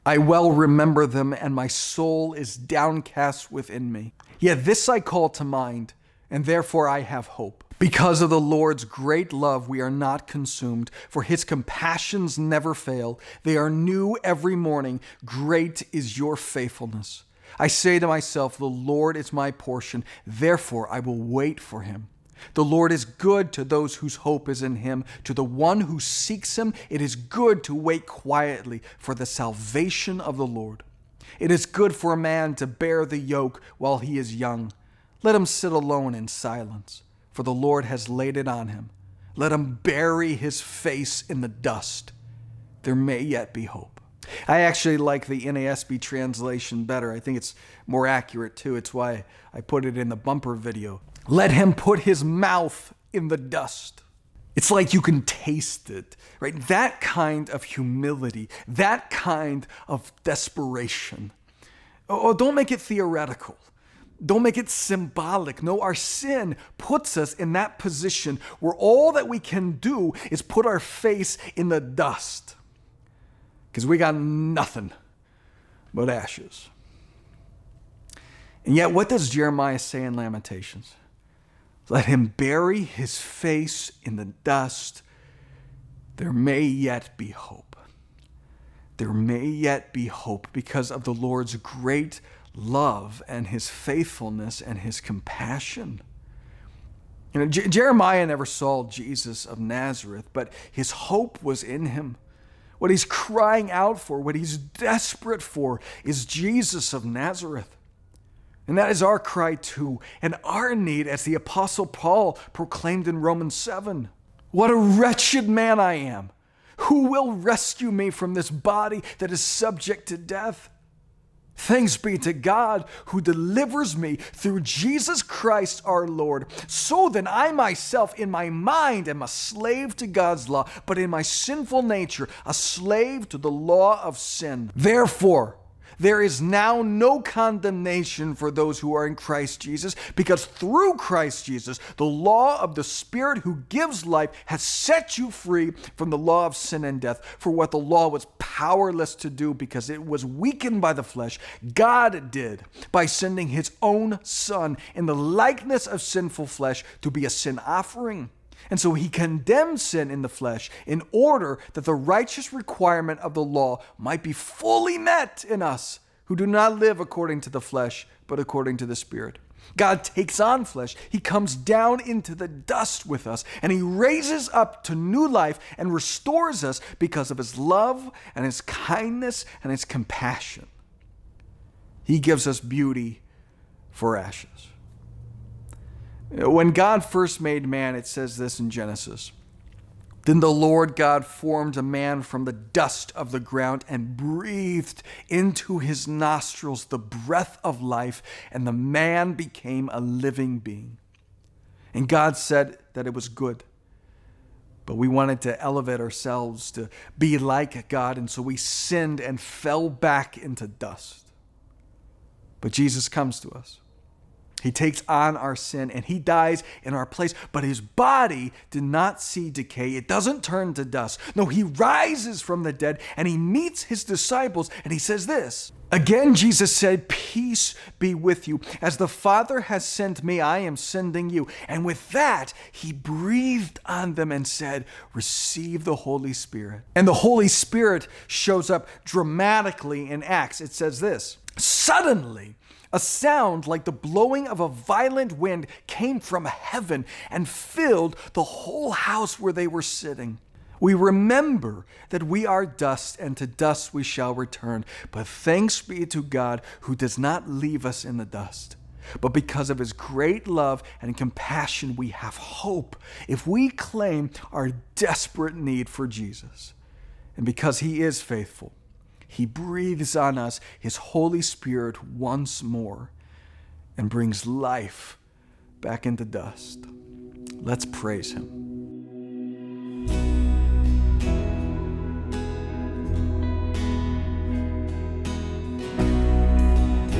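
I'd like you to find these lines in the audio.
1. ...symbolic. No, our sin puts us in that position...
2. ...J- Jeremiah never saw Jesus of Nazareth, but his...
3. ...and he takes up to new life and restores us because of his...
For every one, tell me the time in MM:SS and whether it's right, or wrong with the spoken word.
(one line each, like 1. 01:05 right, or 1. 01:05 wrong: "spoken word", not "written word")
1. 01:04 right
2. 01:37 right
3. 02:53 wrong: "raises", not "takes".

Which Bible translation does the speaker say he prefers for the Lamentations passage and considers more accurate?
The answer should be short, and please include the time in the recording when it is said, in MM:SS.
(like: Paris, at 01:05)
NASB, at 00:45.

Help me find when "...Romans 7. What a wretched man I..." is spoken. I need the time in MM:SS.
01:53.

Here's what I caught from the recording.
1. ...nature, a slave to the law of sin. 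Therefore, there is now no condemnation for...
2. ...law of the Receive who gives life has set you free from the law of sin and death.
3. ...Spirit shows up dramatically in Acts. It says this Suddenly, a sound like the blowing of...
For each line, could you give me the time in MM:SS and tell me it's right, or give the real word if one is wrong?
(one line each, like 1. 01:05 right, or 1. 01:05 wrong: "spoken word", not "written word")
1. 02:11 right
2. 02:22 wrong: "Spirit", not "Receive"
3. 03:57 right.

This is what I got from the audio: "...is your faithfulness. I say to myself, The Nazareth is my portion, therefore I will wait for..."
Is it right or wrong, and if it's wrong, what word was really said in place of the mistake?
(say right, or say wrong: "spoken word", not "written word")
wrong: "Lord", not "Nazareth".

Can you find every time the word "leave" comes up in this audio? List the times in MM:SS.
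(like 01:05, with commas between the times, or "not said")
04:17.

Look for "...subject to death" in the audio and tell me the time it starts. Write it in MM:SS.
01:59.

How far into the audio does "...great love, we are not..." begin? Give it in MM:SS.
00:08.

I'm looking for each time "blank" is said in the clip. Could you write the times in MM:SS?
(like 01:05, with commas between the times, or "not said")
not said.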